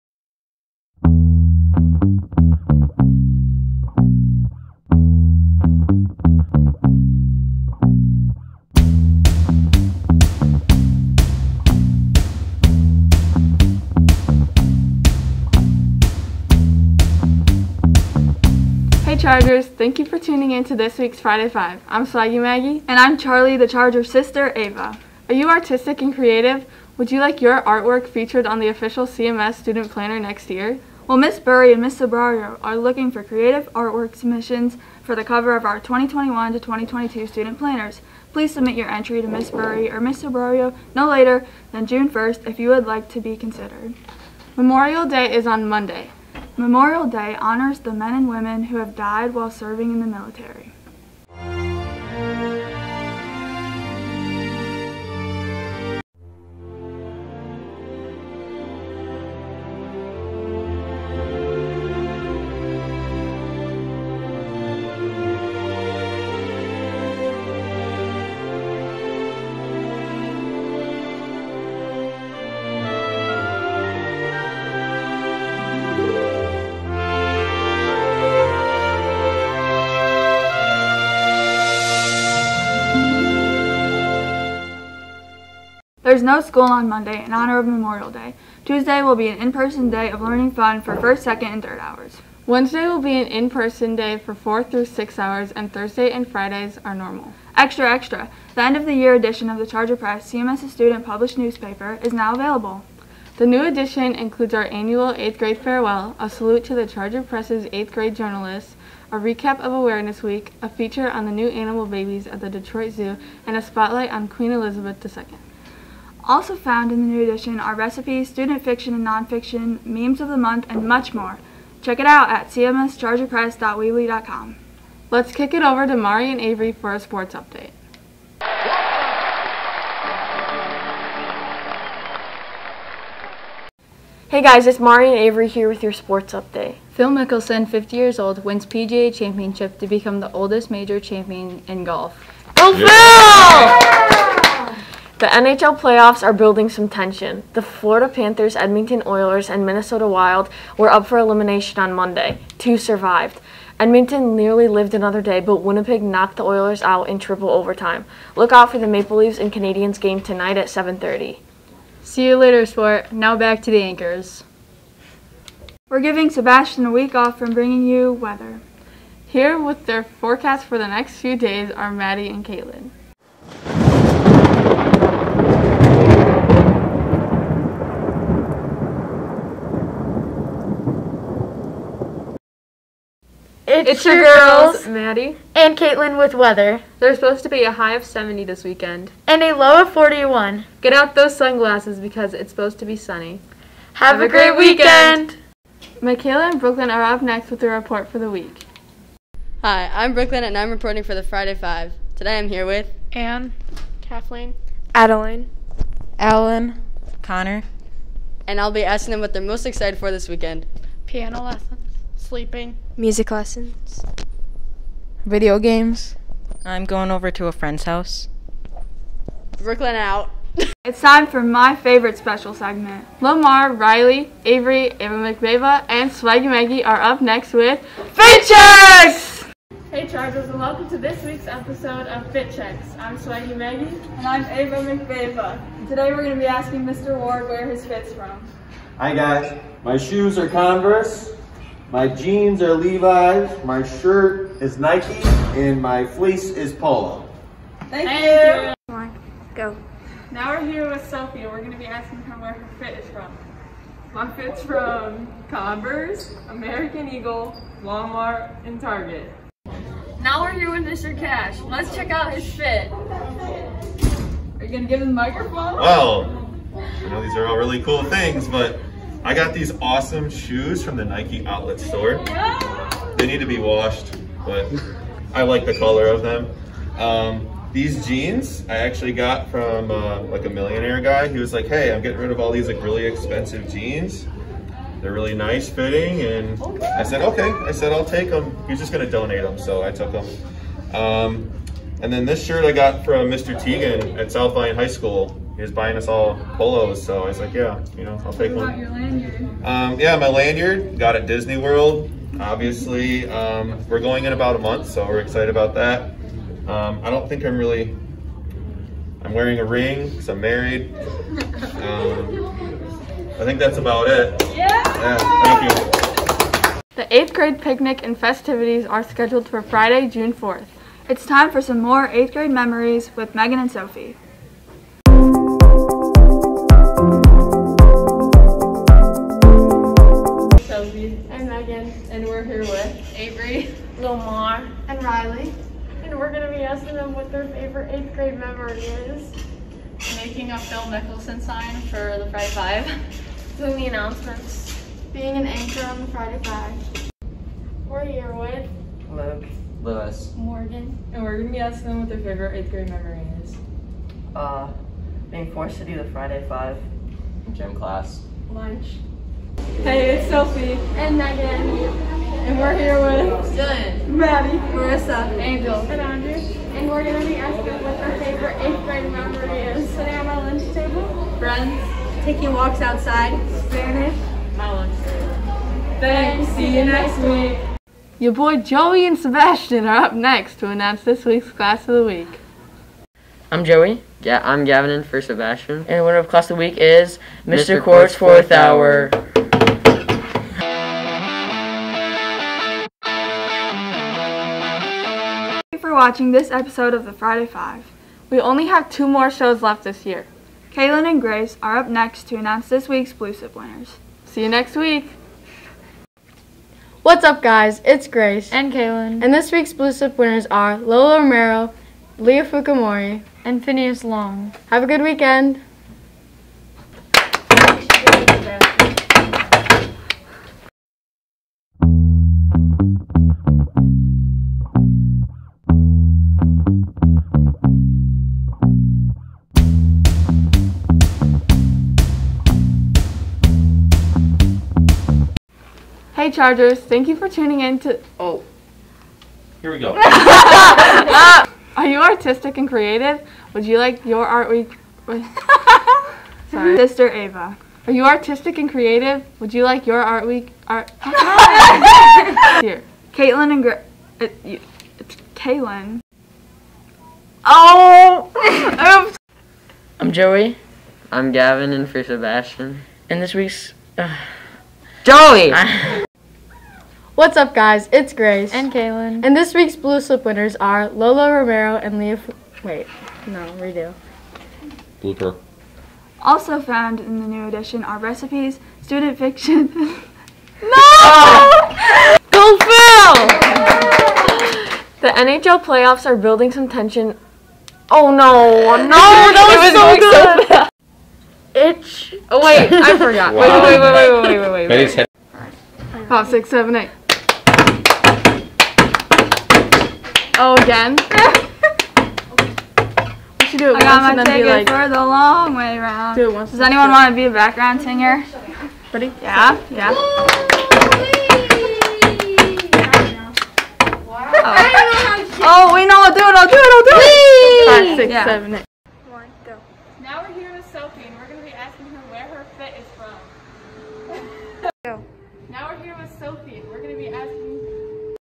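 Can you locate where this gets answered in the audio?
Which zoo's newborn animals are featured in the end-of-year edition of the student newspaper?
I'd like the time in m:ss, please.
1:52.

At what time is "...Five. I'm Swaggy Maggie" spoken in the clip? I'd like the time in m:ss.
0:21.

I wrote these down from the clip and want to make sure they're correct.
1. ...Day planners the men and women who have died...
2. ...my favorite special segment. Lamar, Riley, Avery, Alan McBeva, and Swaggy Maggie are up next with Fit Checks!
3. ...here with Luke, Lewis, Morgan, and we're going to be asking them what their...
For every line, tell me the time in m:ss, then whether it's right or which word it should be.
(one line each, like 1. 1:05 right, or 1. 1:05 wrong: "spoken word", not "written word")
1. 0:47 wrong: "honors", not "planners"
2. 3:41 wrong: "Ava", not "Alan"
3. 5:48 right.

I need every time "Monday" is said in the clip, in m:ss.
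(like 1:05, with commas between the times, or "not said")
0:45, 1:26, 2:31.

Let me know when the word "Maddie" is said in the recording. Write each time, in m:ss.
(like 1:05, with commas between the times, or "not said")
2:51, 3:04, 6:04.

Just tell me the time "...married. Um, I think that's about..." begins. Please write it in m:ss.
5:10.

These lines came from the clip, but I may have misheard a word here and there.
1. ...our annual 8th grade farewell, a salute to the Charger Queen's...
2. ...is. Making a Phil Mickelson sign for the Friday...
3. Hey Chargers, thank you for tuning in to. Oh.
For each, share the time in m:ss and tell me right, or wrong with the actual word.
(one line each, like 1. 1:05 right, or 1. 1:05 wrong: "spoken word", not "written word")
1. 1:44 wrong: "Press", not "Queen"
2. 5:38 right
3. 7:16 right.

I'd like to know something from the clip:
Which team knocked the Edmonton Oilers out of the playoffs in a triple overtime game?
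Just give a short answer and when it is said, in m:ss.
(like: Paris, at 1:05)
Winnipeg, at 2:35.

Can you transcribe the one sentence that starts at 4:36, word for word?
Um, these jeans I actually got from uh, like a millionaire guy.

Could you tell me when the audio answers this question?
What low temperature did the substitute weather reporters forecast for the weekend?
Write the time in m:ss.
3:09.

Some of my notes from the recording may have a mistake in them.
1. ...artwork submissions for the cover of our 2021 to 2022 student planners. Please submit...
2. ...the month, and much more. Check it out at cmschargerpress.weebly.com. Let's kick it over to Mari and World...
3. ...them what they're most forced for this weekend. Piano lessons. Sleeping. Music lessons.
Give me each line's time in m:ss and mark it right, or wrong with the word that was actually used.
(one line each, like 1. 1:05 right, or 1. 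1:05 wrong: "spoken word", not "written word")
1. 0:33 right
2. 2:00 wrong: "Avery", not "World"
3. 3:29 wrong: "excited", not "forced".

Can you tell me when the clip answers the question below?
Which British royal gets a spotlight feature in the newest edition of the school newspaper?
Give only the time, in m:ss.
1:54.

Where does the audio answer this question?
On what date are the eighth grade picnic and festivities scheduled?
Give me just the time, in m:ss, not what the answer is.
5:19.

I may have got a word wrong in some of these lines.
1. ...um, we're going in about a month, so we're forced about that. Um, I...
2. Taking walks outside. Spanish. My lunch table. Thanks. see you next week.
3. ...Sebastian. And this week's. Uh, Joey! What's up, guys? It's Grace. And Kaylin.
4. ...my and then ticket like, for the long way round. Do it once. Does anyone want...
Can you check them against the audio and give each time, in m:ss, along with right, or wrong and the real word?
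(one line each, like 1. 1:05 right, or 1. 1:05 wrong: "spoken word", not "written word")
1. 5:03 wrong: "excited", not "forced"
2. 6:12 right
3. 7:42 right
4. 8:24 right.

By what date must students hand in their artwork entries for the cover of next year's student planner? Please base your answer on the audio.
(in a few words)
June 1st.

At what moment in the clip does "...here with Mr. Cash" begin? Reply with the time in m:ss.
4:20.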